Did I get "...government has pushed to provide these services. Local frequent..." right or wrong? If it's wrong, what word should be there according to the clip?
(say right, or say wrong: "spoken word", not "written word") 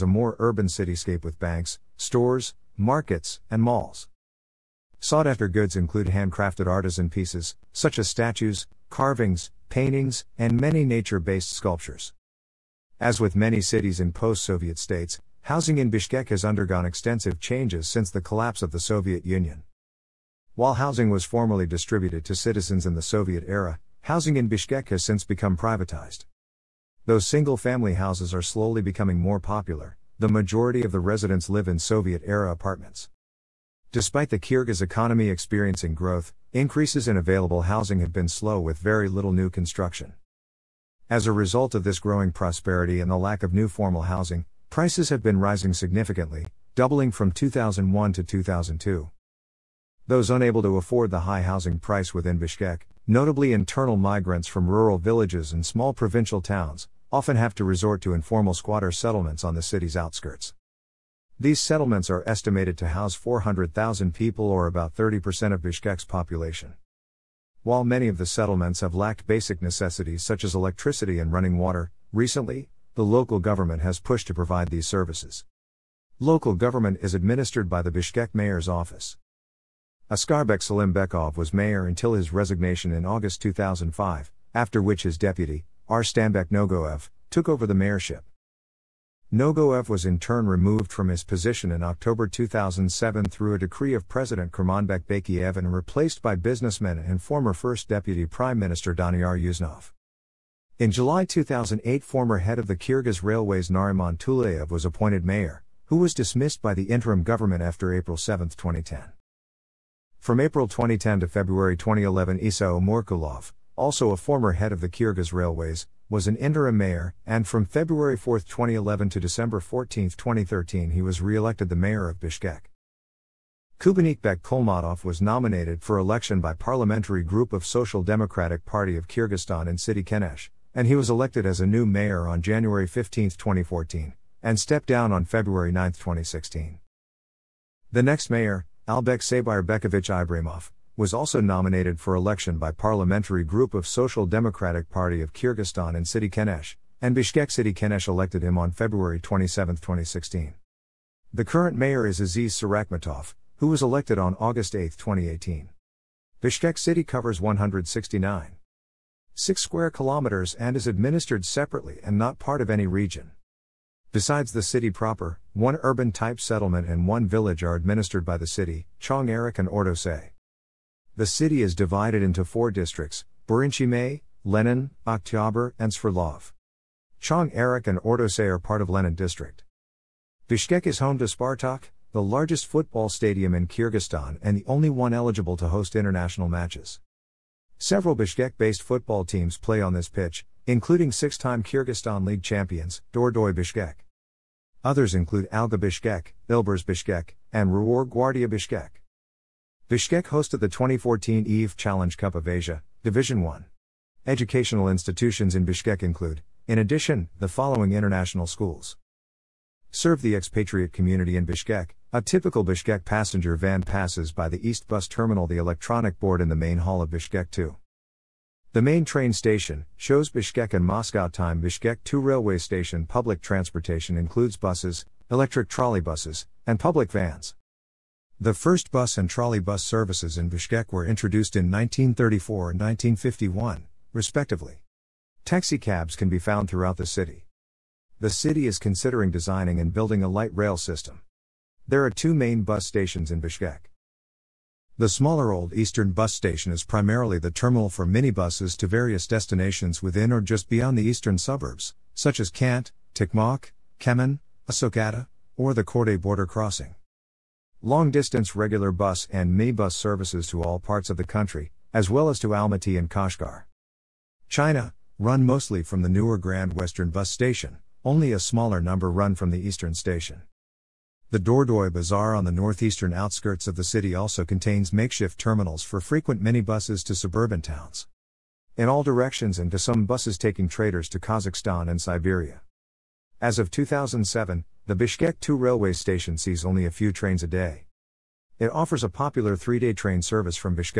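wrong: "government", not "frequent".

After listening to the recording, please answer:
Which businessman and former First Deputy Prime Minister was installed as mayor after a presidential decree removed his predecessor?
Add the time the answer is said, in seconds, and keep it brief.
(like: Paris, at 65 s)
Daniyar Usenov, at 98 s.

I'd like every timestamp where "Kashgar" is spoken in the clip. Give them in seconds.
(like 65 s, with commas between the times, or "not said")
263 s.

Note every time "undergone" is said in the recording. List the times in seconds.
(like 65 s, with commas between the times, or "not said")
16 s.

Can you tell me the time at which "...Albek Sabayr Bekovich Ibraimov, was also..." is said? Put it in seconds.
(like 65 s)
138 s.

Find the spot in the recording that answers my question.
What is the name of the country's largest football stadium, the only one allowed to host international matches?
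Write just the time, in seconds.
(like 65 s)
181 s.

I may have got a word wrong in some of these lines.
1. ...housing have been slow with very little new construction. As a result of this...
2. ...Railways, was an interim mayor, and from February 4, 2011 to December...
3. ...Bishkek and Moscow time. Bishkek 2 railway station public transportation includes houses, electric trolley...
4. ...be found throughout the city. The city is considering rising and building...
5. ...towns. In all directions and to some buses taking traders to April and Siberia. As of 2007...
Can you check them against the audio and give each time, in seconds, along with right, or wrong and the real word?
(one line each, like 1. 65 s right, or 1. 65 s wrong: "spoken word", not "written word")
1. 37 s right
2. 115 s right
3. 220 s wrong: "buses", not "houses"
4. 236 s wrong: "designing", not "rising"
5. 277 s wrong: "Kazakhstan", not "April".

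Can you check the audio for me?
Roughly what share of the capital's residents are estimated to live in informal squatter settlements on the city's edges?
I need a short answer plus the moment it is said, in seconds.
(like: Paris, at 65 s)
30%, at 64 s.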